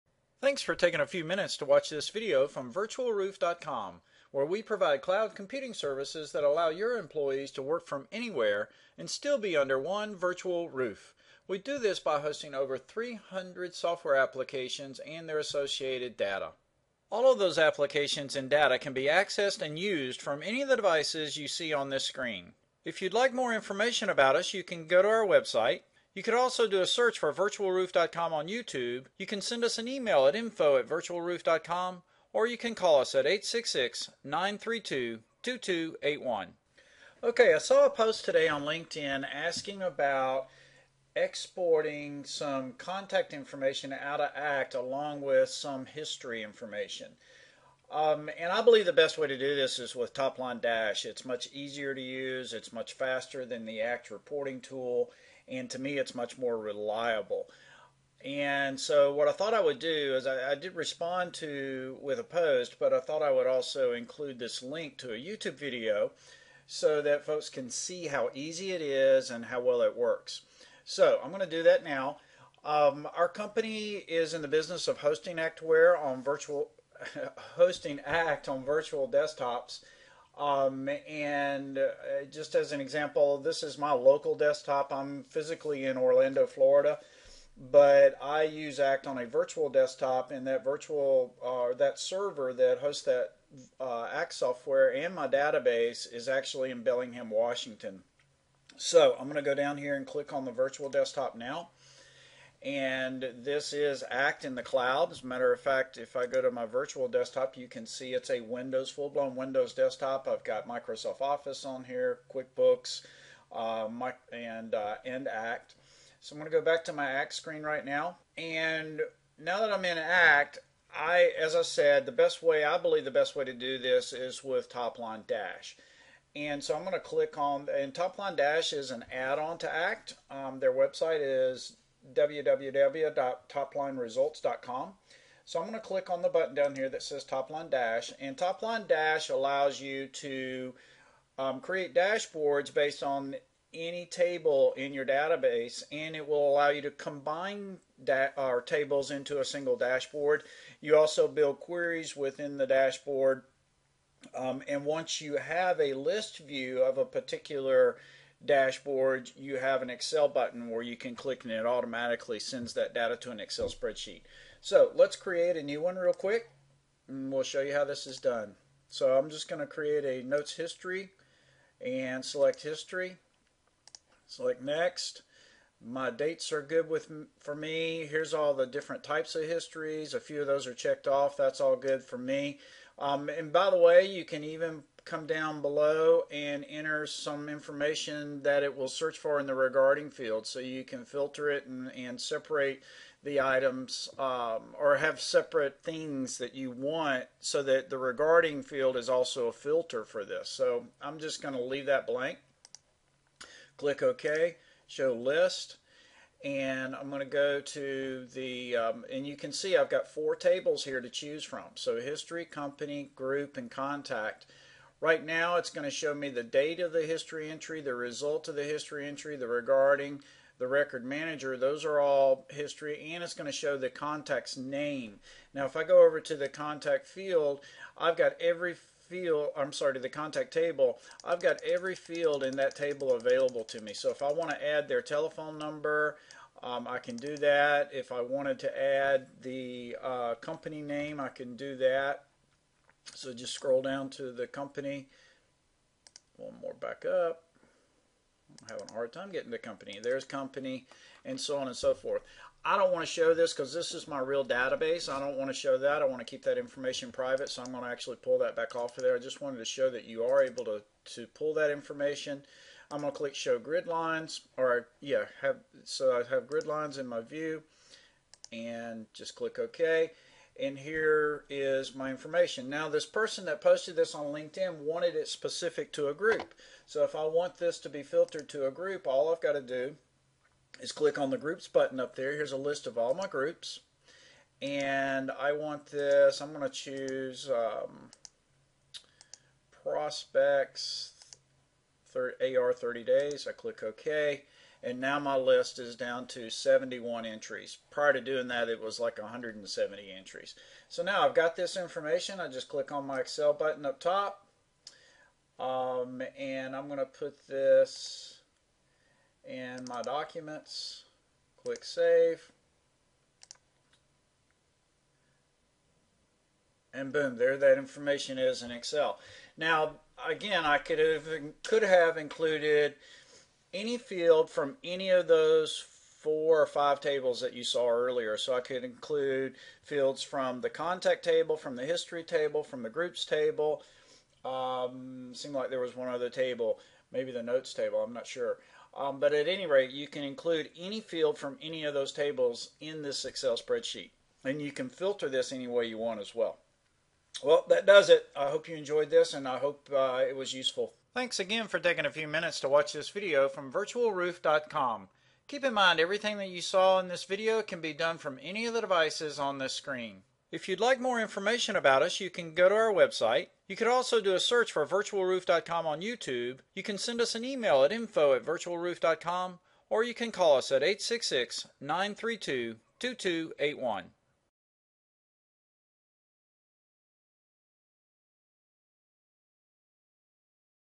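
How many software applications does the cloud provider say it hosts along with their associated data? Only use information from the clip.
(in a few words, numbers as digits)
over 300.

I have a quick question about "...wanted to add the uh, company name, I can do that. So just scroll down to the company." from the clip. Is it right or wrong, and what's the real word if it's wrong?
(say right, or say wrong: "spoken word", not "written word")
right.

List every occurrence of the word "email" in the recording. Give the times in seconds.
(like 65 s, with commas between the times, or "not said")
29 s, 367 s.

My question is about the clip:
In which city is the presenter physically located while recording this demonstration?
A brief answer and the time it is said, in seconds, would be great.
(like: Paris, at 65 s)
Orlando, Florida, at 85 s.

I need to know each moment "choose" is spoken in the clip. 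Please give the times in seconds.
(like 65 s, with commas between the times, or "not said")
211 s, 286 s.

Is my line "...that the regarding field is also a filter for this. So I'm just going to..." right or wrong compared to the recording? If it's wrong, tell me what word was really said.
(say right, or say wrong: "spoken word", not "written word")
right.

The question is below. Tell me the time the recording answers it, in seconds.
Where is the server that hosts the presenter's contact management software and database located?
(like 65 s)
96 s.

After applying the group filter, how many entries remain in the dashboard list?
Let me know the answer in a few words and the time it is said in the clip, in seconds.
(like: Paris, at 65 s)
71, at 296 s.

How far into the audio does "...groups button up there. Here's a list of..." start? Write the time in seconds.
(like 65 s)
281 s.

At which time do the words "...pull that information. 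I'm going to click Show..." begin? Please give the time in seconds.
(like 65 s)
261 s.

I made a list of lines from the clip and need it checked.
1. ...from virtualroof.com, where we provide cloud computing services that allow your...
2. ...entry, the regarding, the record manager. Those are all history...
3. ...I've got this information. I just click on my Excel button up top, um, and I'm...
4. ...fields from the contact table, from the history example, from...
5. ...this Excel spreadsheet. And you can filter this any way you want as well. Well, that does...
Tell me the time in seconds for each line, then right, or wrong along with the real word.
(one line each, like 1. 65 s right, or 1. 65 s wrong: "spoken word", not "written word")
1. 2 s right
2. 219 s right
3. 301 s right
4. 329 s wrong: "table", not "example"
5. 343 s right.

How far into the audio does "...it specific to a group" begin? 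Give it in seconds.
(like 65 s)
275 s.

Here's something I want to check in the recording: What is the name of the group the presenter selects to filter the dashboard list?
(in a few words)
prospects, AR 30 days.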